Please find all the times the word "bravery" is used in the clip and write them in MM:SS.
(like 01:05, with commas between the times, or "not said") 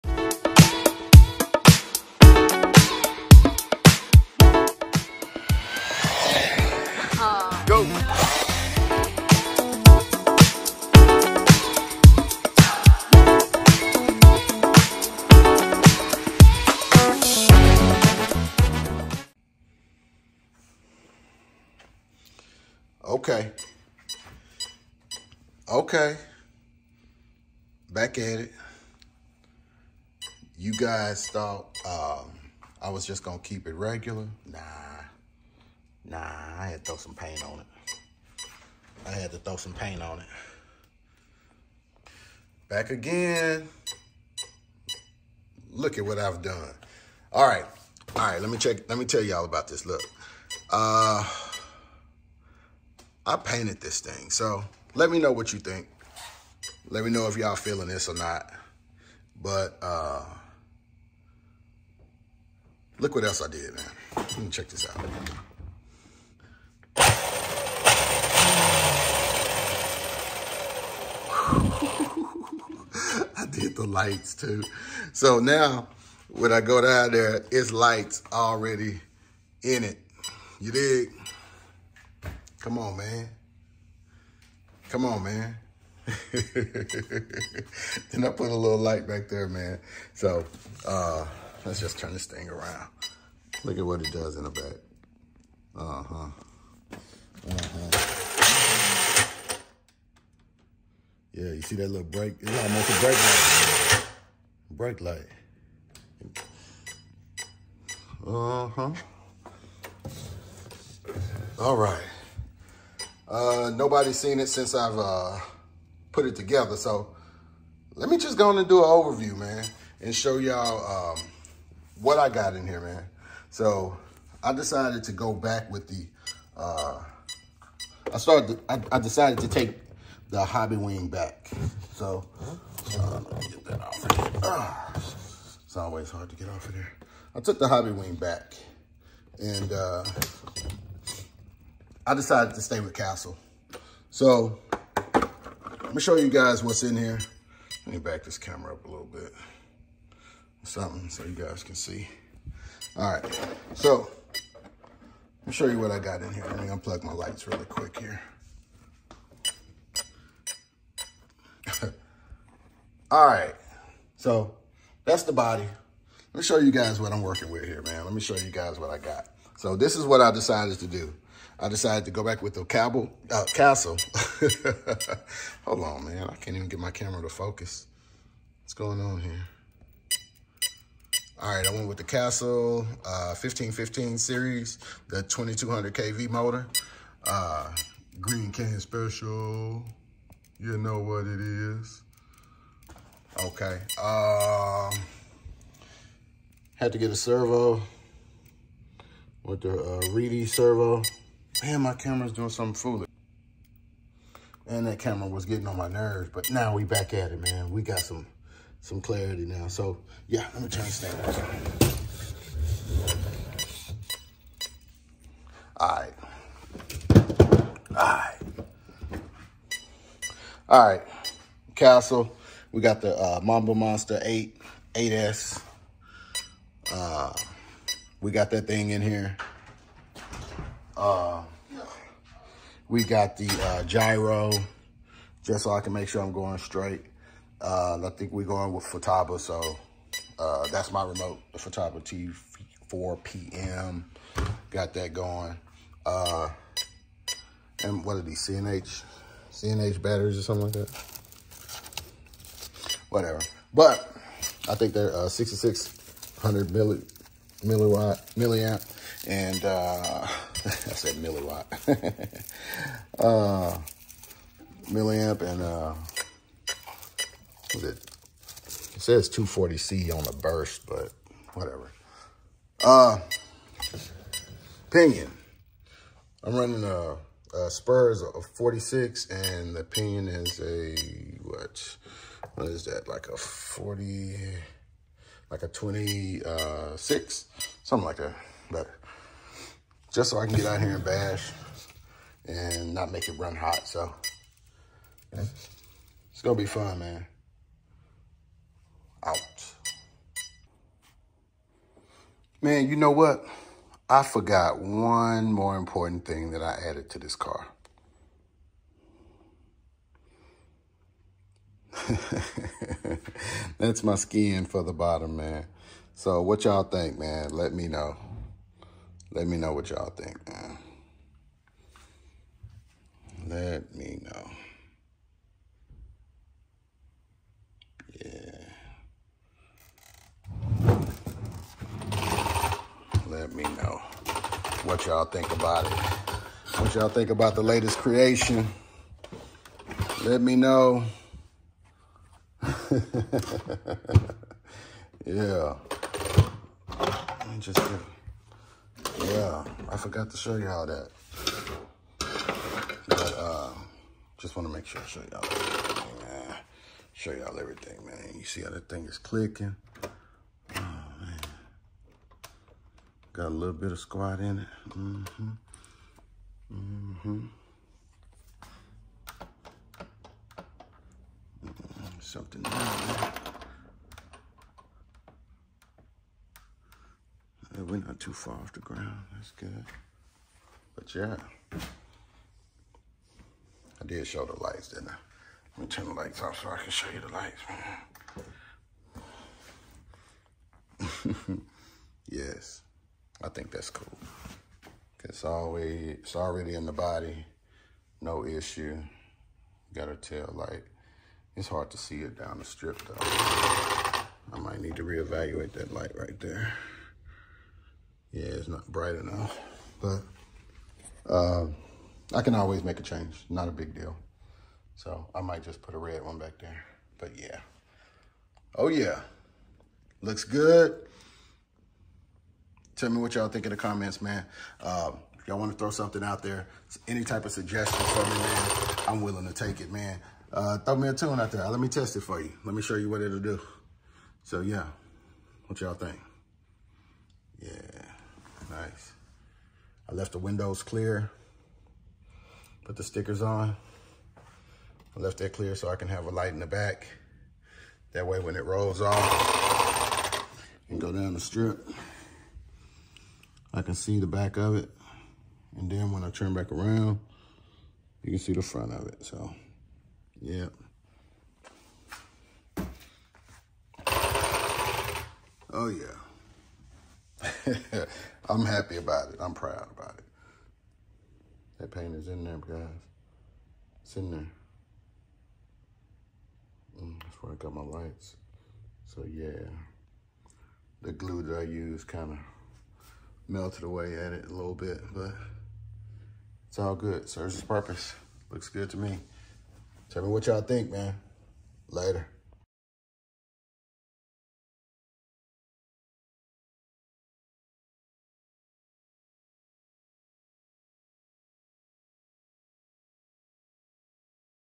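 not said.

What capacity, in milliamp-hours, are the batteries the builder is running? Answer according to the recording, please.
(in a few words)
6600.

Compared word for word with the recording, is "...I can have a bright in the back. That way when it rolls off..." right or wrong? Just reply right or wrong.
wrong.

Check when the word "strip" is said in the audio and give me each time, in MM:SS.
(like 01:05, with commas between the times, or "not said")
06:42, 07:31.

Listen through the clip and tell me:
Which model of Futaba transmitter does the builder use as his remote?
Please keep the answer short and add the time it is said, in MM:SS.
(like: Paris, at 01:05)
Futaba T4PM, at 04:01.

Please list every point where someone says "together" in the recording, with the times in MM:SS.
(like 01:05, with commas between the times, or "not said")
01:56.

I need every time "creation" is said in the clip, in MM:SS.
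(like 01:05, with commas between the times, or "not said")
05:37.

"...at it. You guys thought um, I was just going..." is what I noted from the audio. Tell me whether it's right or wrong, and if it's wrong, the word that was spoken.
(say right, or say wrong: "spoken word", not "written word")
right.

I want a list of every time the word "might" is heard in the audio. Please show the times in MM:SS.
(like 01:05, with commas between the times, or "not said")
06:44, 06:55.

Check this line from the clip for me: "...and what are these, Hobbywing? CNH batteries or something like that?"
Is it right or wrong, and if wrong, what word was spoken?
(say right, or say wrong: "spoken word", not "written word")
wrong: "CNH", not "Hobbywing".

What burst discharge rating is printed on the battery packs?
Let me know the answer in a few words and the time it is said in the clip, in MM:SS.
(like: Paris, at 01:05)
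240C, at 04:29.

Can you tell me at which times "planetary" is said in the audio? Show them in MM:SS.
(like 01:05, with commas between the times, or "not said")
not said.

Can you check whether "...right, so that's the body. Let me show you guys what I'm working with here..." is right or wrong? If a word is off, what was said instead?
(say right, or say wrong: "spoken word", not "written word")
right.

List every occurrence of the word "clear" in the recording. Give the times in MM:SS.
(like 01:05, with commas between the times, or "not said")
07:20, 07:25.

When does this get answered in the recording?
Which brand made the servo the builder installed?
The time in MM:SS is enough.
03:20.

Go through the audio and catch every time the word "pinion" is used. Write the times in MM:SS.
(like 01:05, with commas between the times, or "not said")
04:34, 04:39.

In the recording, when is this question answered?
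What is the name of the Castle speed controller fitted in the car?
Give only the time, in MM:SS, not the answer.
03:43.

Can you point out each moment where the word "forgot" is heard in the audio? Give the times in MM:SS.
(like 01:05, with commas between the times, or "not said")
05:04, 05:49.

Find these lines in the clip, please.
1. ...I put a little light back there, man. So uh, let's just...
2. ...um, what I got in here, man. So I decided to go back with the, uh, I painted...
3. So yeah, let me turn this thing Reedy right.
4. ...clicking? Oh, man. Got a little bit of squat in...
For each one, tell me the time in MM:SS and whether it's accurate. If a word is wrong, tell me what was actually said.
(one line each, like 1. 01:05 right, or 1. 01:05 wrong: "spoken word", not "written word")
1. 01:28 right
2. 02:01 wrong: "started", not "painted"
3. 03:29 wrong: "All", not "Reedy"
4. 05:59 right.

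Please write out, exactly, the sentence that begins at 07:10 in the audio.
Uh, throw me a tune out there.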